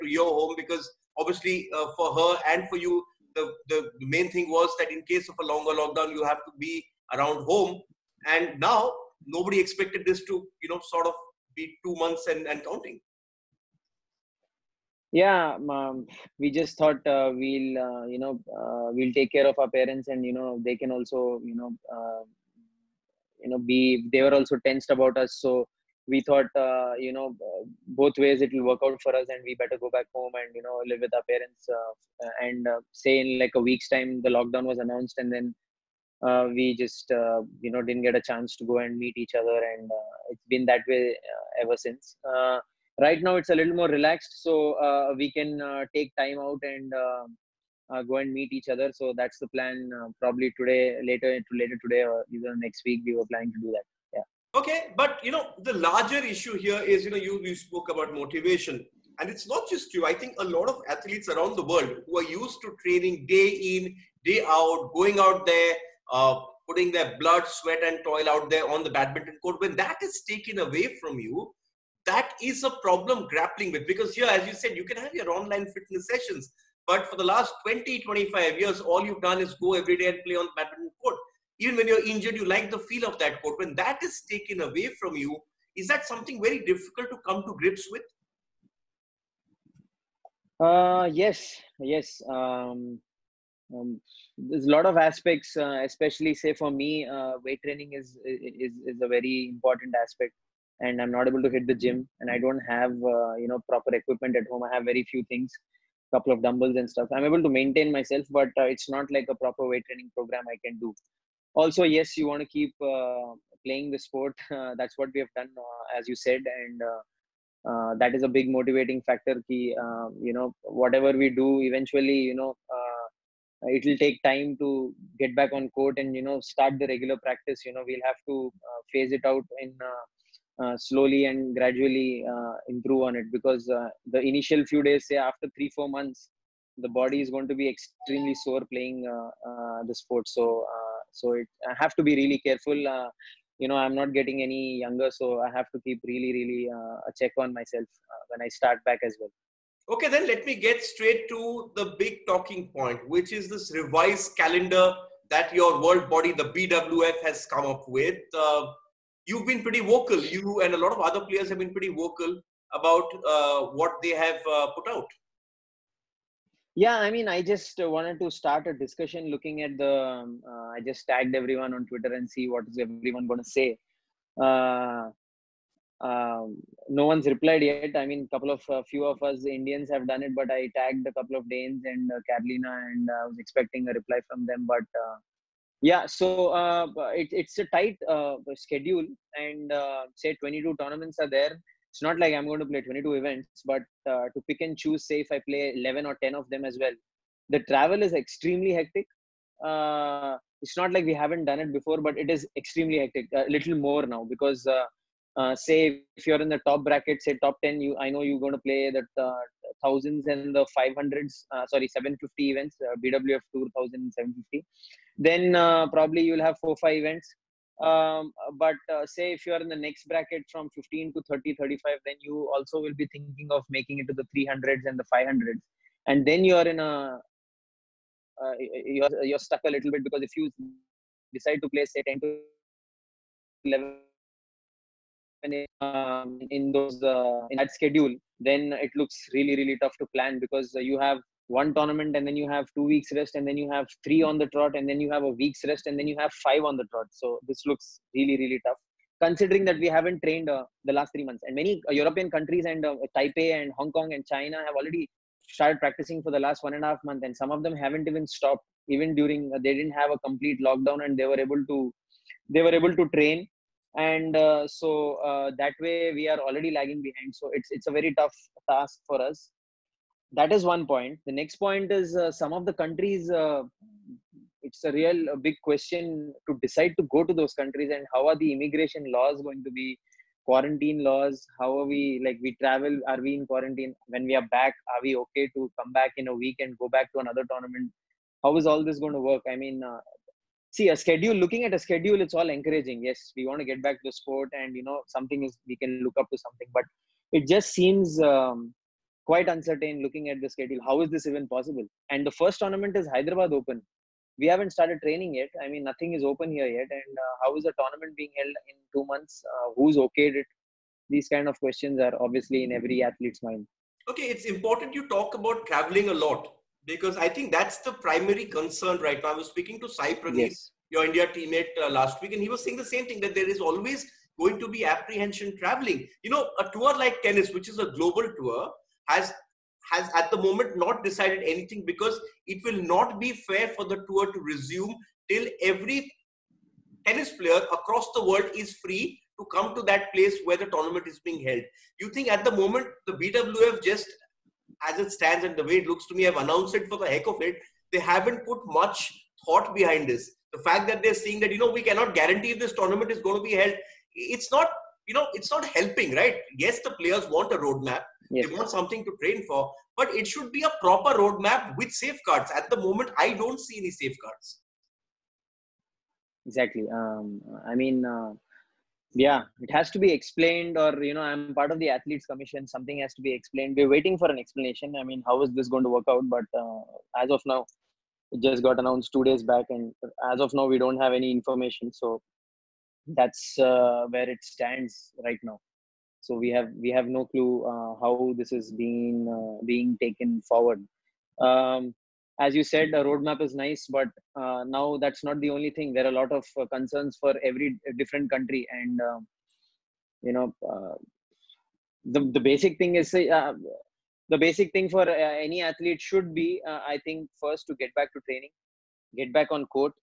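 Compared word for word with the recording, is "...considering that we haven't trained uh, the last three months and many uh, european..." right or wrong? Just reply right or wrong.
right.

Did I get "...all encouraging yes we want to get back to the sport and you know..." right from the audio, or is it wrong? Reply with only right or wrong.
right.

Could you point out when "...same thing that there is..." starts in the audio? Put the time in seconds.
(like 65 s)
322 s.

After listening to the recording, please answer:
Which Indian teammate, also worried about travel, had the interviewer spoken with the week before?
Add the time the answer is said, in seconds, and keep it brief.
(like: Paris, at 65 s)
Sai Praneeth, at 319 s.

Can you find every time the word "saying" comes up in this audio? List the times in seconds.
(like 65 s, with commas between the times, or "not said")
322 s, 351 s.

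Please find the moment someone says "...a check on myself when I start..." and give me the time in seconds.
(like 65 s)
147 s.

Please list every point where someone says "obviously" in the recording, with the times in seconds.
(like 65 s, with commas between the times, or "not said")
1 s, 312 s.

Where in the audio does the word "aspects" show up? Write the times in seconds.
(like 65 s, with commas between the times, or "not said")
94 s, 100 s.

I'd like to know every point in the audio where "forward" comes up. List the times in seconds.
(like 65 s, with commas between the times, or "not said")
390 s.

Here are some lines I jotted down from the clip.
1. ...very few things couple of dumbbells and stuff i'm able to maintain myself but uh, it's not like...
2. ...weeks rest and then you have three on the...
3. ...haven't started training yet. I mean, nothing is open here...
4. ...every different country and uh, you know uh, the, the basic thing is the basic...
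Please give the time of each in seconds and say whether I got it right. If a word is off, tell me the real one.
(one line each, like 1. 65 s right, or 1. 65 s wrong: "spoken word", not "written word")
1. 104 s right
2. 242 s right
3. 304 s right
4. 397 s right.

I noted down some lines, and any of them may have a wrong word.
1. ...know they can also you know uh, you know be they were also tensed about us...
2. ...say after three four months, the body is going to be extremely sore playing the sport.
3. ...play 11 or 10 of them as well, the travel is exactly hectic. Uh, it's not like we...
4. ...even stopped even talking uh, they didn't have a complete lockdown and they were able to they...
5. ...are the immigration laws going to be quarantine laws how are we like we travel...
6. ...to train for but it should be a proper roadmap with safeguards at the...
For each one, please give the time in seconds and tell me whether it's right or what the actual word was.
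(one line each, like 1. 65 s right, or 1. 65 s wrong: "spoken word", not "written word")
1. 20 s right
2. 135 s right
3. 195 s wrong: "extremely", not "exactly"
4. 258 s wrong: "during", not "talking"
5. 278 s right
6. 359 s right.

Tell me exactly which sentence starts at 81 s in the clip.
Even when you're injured, you like the feel of that court.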